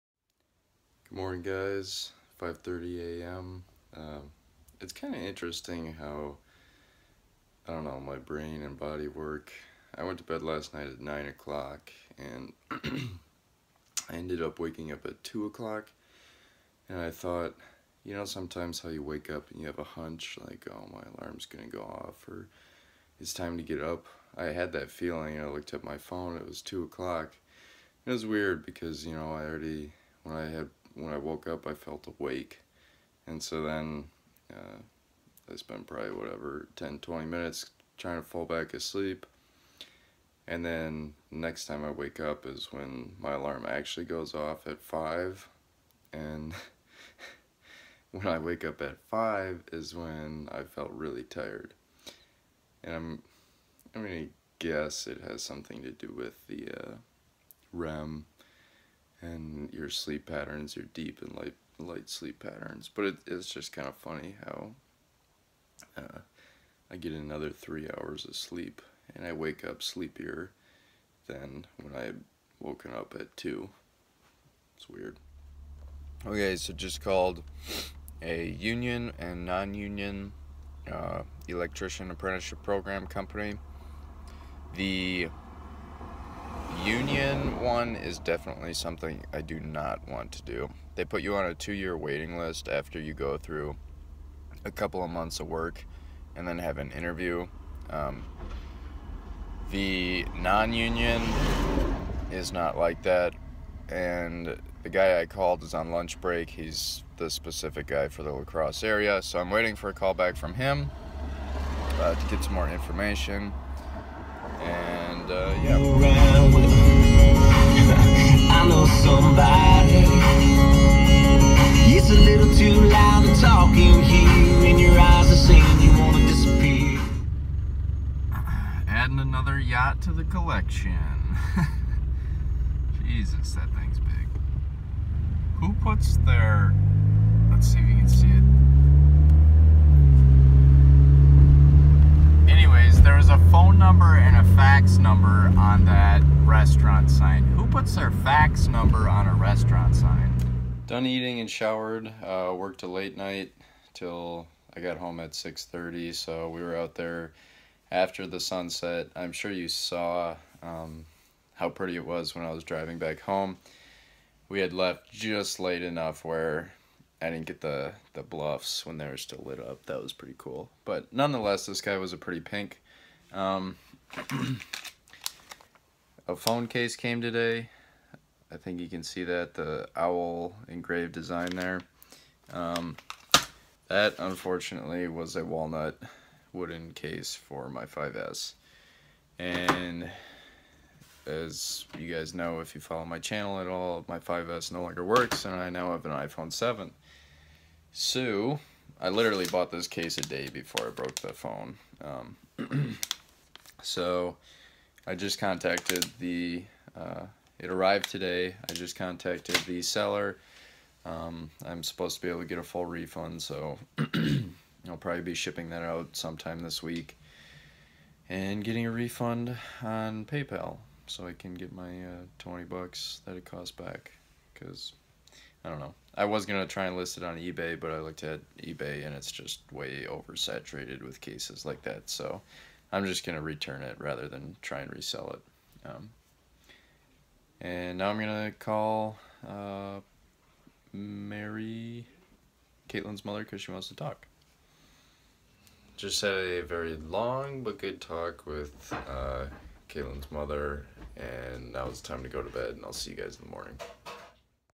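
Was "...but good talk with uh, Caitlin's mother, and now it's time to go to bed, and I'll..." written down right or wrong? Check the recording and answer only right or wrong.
right.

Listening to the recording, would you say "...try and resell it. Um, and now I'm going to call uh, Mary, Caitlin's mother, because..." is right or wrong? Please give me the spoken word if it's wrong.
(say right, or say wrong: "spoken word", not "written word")
right.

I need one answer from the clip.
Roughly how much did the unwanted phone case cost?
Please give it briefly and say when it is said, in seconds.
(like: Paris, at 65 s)
$20, at 222 s.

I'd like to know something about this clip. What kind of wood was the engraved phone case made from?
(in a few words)
Walnut.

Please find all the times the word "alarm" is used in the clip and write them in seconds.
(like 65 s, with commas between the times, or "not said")
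21 s, 43 s.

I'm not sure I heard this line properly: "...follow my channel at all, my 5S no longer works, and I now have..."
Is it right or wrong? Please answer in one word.
right.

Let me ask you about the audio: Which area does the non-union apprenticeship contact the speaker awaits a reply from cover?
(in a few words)
La Crosse.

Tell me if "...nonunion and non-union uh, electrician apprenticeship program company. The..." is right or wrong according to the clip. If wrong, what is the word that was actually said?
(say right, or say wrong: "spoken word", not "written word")
wrong: "union", not "nonunion".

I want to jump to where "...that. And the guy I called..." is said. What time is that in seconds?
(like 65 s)
103 s.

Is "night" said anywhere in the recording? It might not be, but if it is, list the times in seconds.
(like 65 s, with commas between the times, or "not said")
10 s, 153 s.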